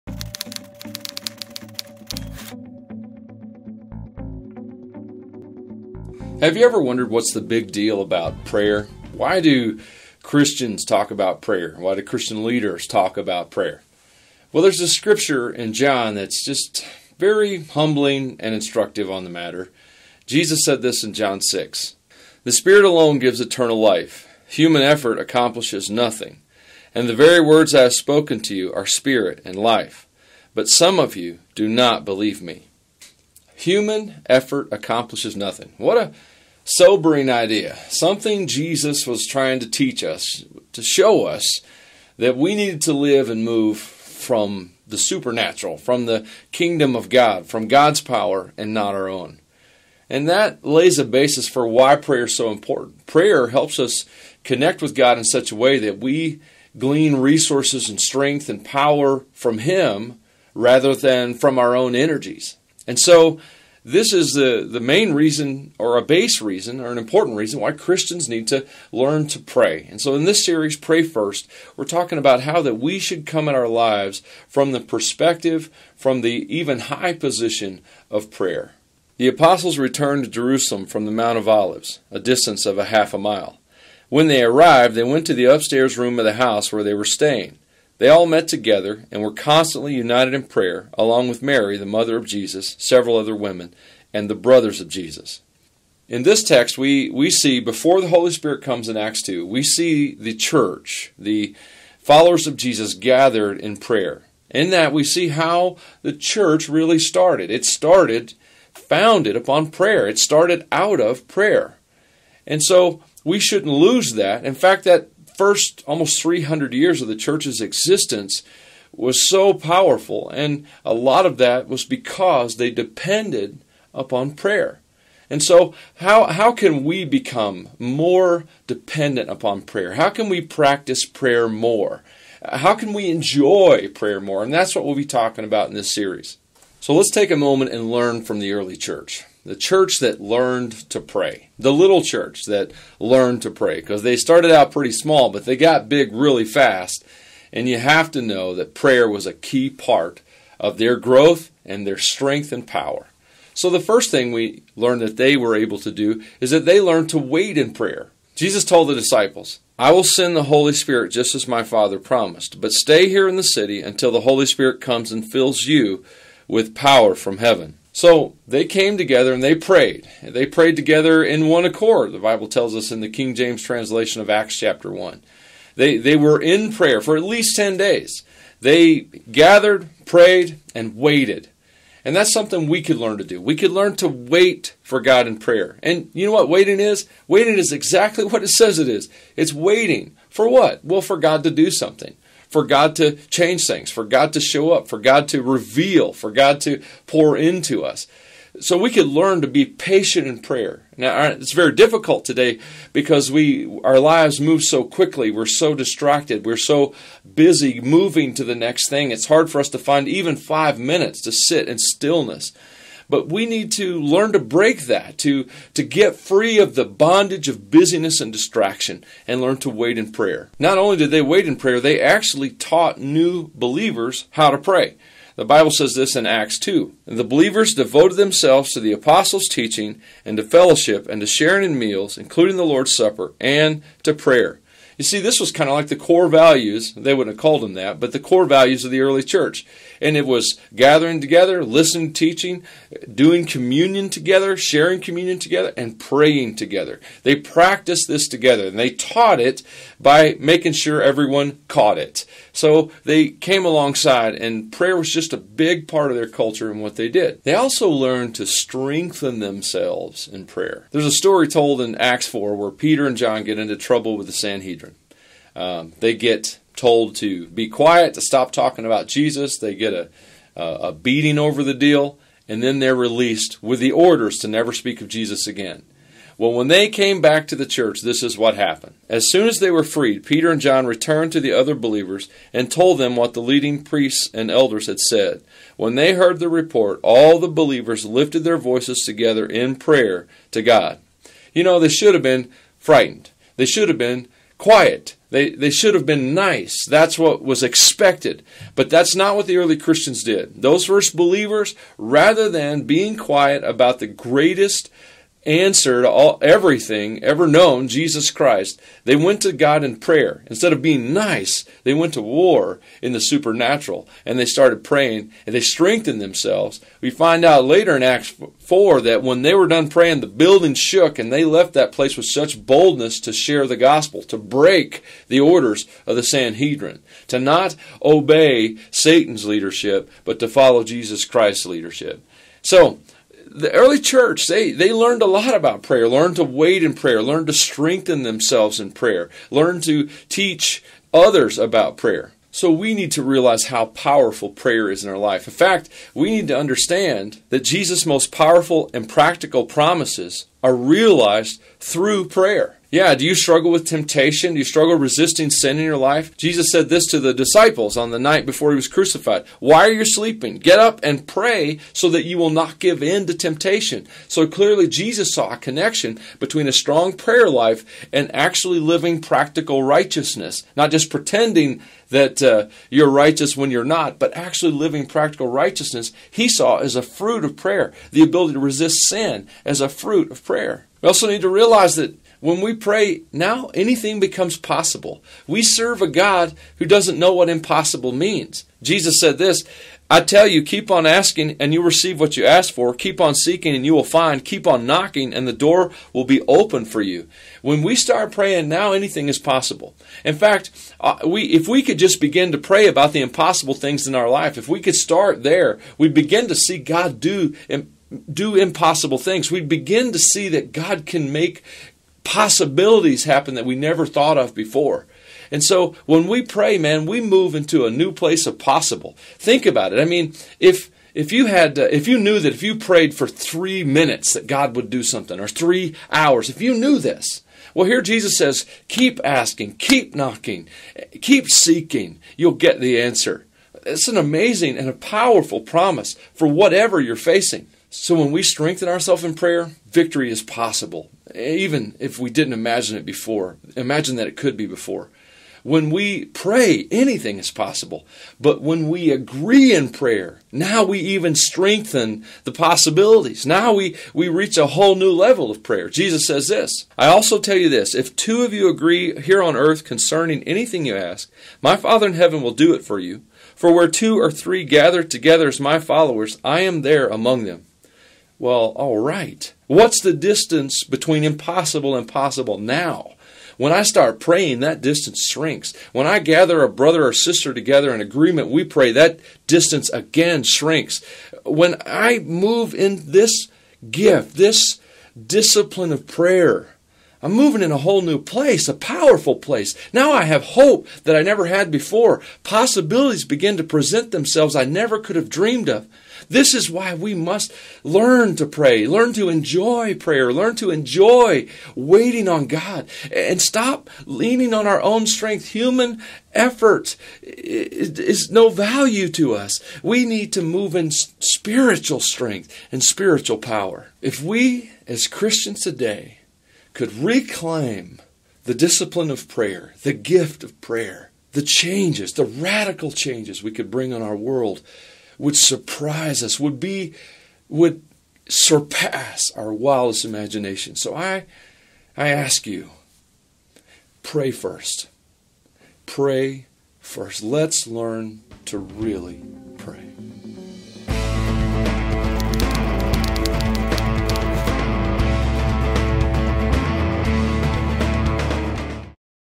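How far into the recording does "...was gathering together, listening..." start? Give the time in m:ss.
4:00.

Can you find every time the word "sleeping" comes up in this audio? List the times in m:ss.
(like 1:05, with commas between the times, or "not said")
6:00.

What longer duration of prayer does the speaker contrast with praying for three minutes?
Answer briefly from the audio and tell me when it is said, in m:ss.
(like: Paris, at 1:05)
3 hours, at 7:05.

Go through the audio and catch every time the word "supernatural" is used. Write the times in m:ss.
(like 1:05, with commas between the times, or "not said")
0:44, 5:13.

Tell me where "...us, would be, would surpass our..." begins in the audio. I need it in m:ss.
8:46.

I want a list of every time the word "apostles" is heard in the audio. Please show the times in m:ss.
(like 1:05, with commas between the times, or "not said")
1:19, 3:48.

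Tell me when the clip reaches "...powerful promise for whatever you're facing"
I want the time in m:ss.
7:14.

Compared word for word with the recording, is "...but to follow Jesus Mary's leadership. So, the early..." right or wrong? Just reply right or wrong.
wrong.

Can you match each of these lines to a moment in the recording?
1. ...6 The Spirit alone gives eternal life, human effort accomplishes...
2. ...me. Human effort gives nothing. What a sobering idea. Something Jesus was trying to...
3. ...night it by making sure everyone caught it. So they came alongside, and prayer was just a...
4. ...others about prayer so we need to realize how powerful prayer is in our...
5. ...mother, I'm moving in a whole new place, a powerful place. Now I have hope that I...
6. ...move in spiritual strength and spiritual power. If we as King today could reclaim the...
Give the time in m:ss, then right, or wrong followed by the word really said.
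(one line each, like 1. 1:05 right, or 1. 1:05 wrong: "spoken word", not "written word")
1. 0:21 right
2. 0:32 wrong: "accomplishes", not "gives"
3. 4:08 wrong: "taught", not "night"
4. 5:41 right
5. 8:06 wrong: "prayer", not "mother"
6. 8:30 wrong: "Christians", not "King".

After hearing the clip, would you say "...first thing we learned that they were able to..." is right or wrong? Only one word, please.
right.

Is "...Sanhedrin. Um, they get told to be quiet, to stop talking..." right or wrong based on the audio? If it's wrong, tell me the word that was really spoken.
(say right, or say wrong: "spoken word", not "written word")
right.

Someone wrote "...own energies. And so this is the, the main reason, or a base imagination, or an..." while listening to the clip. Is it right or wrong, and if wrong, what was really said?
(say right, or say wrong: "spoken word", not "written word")
wrong: "reason", not "imagination".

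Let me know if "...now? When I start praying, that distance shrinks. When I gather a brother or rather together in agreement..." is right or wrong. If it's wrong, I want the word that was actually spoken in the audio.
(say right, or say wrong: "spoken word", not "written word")
wrong: "sister", not "rather".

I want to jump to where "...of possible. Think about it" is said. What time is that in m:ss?
6:58.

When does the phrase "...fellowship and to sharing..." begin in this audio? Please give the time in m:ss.
3:50.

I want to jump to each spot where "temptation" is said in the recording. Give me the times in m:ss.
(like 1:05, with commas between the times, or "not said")
5:53, 6:03.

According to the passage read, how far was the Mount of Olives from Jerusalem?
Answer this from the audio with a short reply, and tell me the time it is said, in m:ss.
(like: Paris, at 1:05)
Half a mile, at 1:22.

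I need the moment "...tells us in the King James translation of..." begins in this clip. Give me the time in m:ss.
2:52.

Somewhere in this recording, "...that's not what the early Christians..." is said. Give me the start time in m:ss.
4:58.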